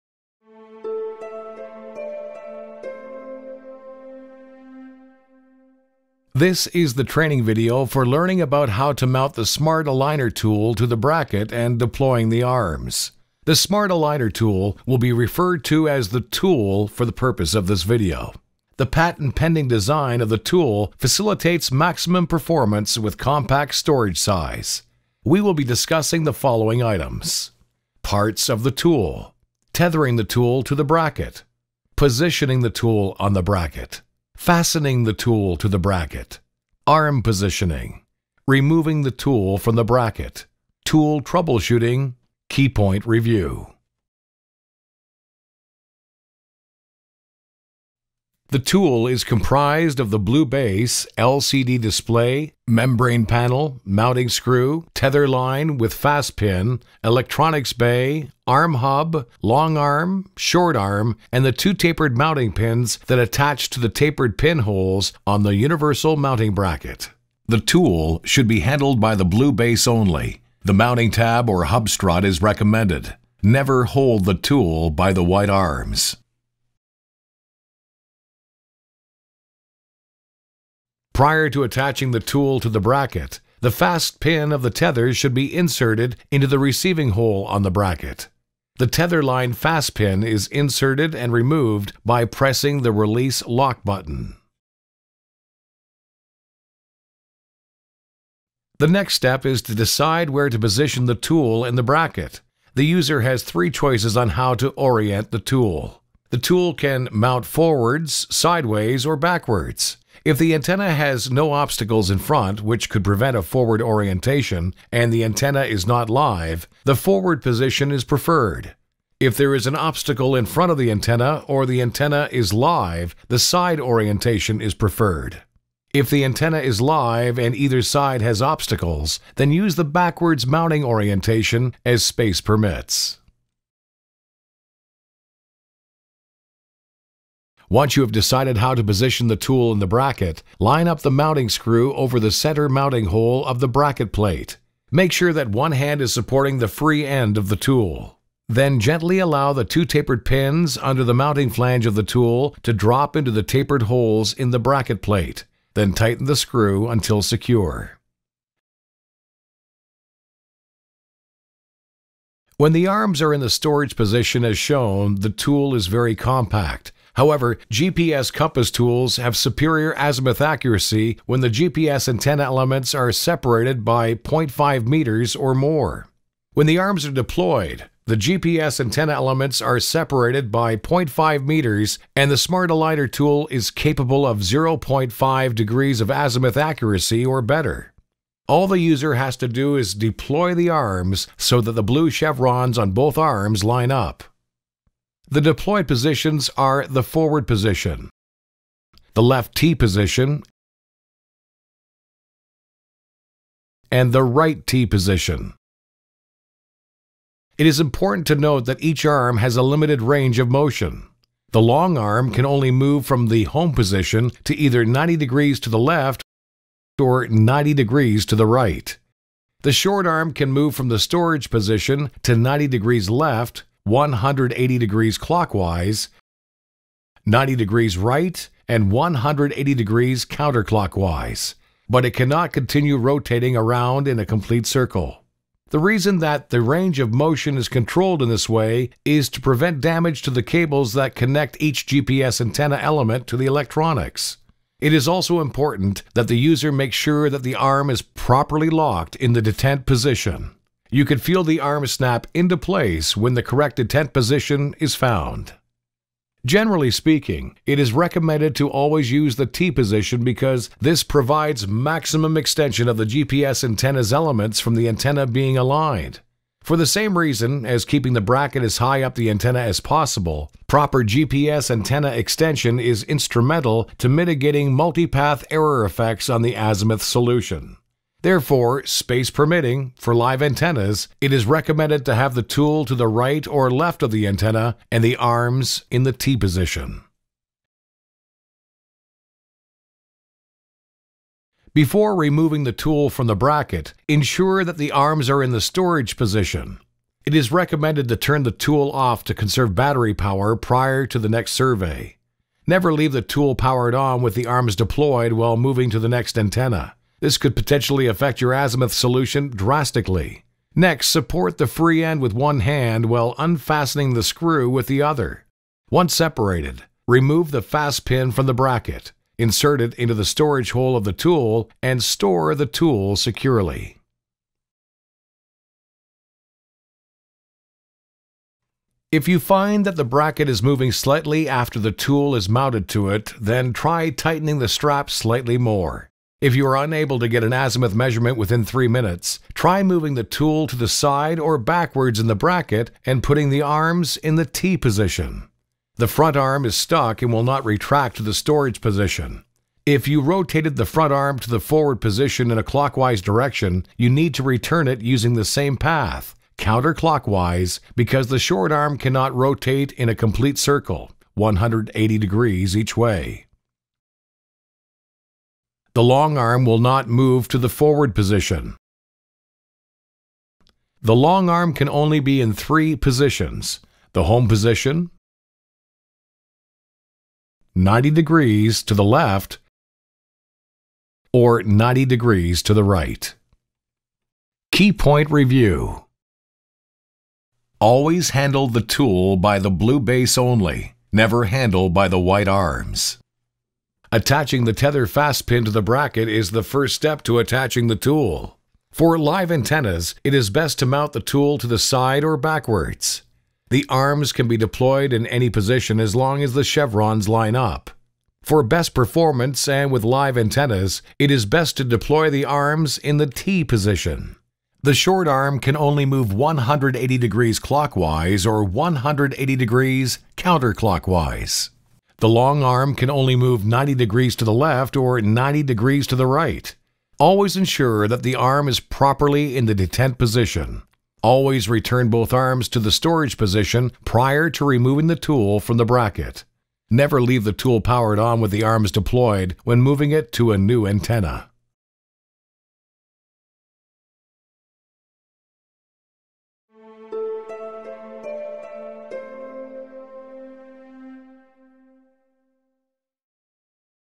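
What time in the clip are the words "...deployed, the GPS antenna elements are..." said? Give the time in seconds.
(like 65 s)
177 s.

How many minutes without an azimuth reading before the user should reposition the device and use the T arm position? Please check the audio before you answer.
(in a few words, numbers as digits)
3.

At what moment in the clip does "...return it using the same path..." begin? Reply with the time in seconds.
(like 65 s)
354 s.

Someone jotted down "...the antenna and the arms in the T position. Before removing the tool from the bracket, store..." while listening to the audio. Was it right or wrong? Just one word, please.
wrong.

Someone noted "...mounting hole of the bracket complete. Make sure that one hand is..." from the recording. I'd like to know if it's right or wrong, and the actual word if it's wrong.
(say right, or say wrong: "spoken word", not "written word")
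wrong: "plate", not "complete".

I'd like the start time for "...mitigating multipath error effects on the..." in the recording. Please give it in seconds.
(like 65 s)
274 s.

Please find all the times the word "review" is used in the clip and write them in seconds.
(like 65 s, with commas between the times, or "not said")
43 s, 385 s.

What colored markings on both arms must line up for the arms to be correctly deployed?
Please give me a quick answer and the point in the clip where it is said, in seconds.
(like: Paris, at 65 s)
blue chevrons, at 191 s.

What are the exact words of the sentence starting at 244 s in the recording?
It is also important that the user make sure that the arm is properly locked in the detent position.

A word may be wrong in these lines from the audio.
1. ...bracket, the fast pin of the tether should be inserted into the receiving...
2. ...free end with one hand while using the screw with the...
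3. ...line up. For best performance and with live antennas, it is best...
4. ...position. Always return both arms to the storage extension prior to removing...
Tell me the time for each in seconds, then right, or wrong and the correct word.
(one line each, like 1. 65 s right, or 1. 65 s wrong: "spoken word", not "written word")
1. 82 s right
2. 311 s wrong: "unfastening", not "using"
3. 407 s right
4. 430 s wrong: "position", not "extension".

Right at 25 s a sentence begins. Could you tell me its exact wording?
We will be discussing the following items.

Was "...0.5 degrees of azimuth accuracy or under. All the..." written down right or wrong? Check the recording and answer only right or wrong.
wrong.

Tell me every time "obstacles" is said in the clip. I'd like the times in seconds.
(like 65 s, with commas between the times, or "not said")
111 s, 119 s, 128 s.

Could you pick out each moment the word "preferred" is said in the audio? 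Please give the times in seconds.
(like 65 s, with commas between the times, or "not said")
118 s, 124 s.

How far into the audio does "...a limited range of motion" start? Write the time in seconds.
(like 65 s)
209 s.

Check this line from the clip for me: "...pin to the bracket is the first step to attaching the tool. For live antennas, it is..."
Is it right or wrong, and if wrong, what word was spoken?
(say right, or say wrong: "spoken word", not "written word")
right.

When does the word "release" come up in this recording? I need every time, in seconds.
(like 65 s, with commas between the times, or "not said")
92 s.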